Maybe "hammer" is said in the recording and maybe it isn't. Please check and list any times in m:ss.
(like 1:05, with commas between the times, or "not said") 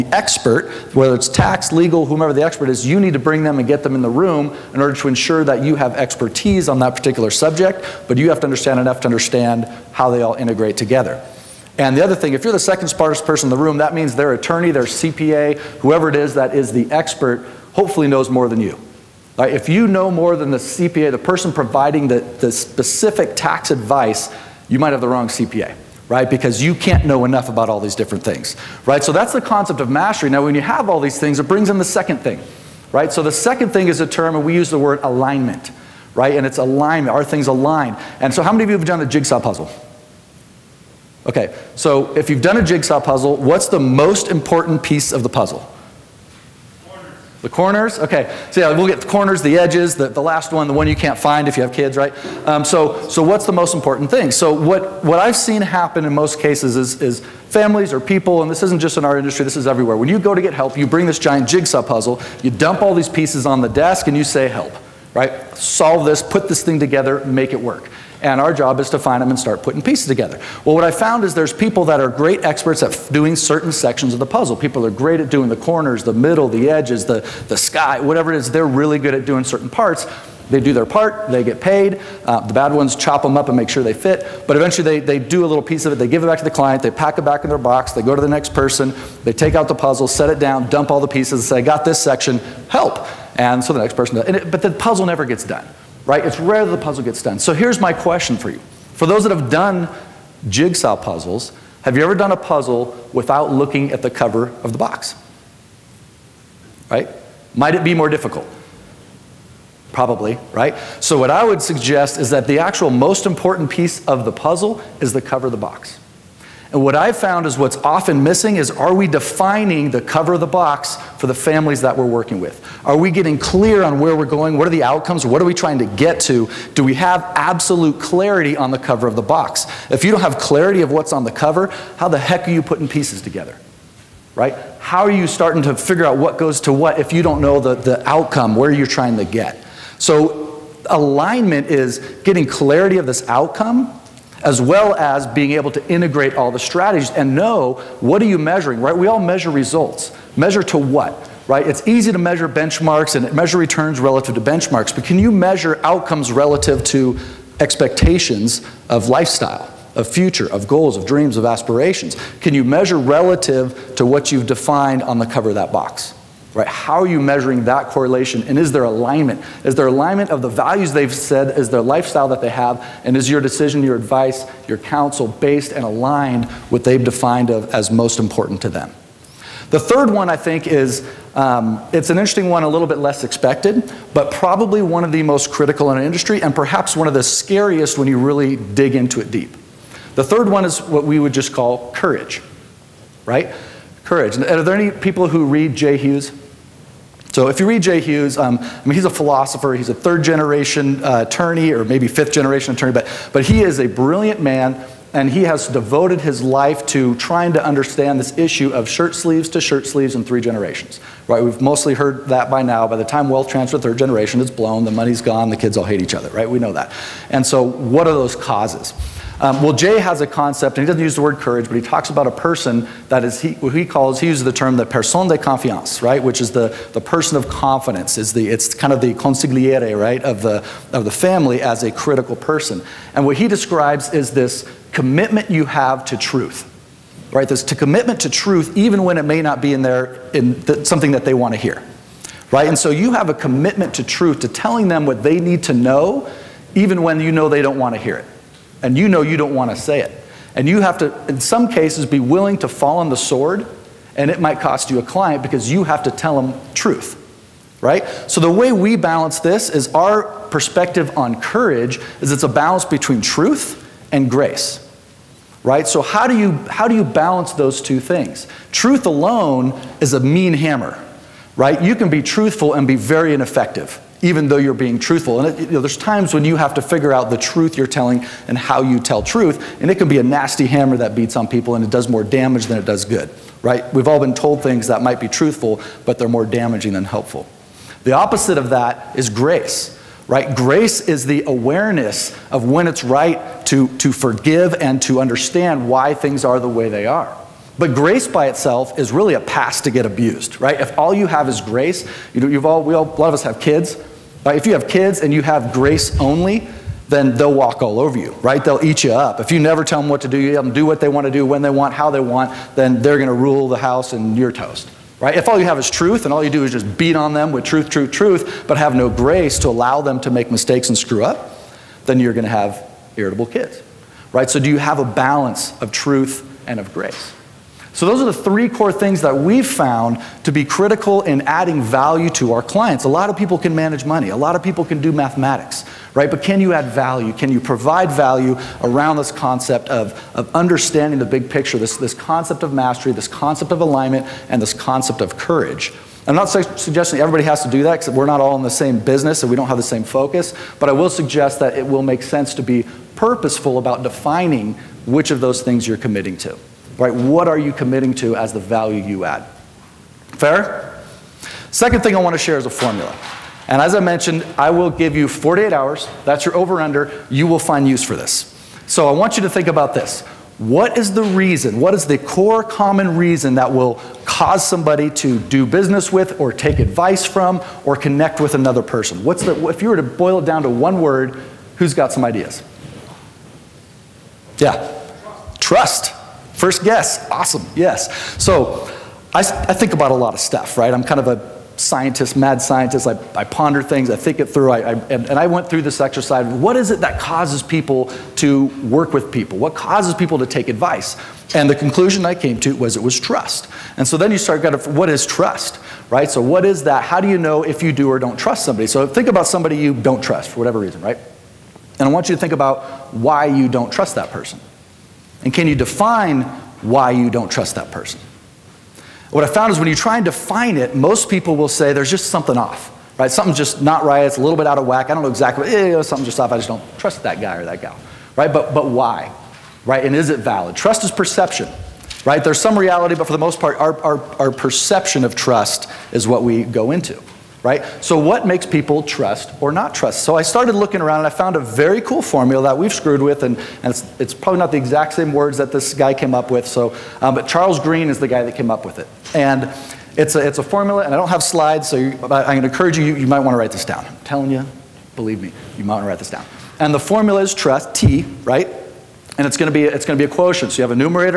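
4:30, 4:40.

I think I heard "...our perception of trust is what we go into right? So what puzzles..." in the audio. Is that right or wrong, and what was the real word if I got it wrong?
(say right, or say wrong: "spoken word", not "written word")
wrong: "makes", not "puzzles".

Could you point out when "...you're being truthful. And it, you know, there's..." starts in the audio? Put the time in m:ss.
4:34.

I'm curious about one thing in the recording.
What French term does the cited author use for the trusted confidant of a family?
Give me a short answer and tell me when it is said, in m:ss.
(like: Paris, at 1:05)
personne de confiance, at 3:44.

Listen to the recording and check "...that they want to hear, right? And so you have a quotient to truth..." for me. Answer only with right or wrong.
wrong.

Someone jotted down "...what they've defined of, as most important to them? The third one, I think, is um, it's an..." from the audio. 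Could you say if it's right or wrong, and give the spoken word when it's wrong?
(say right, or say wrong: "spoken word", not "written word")
right.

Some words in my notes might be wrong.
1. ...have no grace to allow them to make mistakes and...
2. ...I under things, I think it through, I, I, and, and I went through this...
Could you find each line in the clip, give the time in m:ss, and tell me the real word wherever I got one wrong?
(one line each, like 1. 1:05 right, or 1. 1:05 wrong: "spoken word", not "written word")
1. 5:18 right
2. 6:33 wrong: "ponder", not "under".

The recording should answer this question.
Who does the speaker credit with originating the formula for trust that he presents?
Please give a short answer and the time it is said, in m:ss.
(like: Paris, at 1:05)
Charles Green, at 7:27.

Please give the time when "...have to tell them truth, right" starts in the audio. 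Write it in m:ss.
4:15.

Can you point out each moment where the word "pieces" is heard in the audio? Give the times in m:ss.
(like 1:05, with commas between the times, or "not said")
0:44, 1:03, 1:09, 1:25, 1:31, 1:53, 2:12.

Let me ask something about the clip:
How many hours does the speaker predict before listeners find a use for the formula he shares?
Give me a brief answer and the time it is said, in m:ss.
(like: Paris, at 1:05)
48, at 6:05.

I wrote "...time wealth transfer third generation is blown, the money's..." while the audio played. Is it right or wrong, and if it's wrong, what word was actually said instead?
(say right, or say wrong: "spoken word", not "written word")
right.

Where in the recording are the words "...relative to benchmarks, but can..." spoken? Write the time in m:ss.
2:33.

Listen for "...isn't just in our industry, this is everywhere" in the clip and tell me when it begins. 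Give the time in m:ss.
0:58.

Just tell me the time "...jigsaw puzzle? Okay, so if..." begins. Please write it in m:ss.
0:39.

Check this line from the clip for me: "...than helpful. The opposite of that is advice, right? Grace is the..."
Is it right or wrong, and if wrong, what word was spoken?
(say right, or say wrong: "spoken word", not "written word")
wrong: "grace", not "advice".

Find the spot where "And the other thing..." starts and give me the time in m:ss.
0:11.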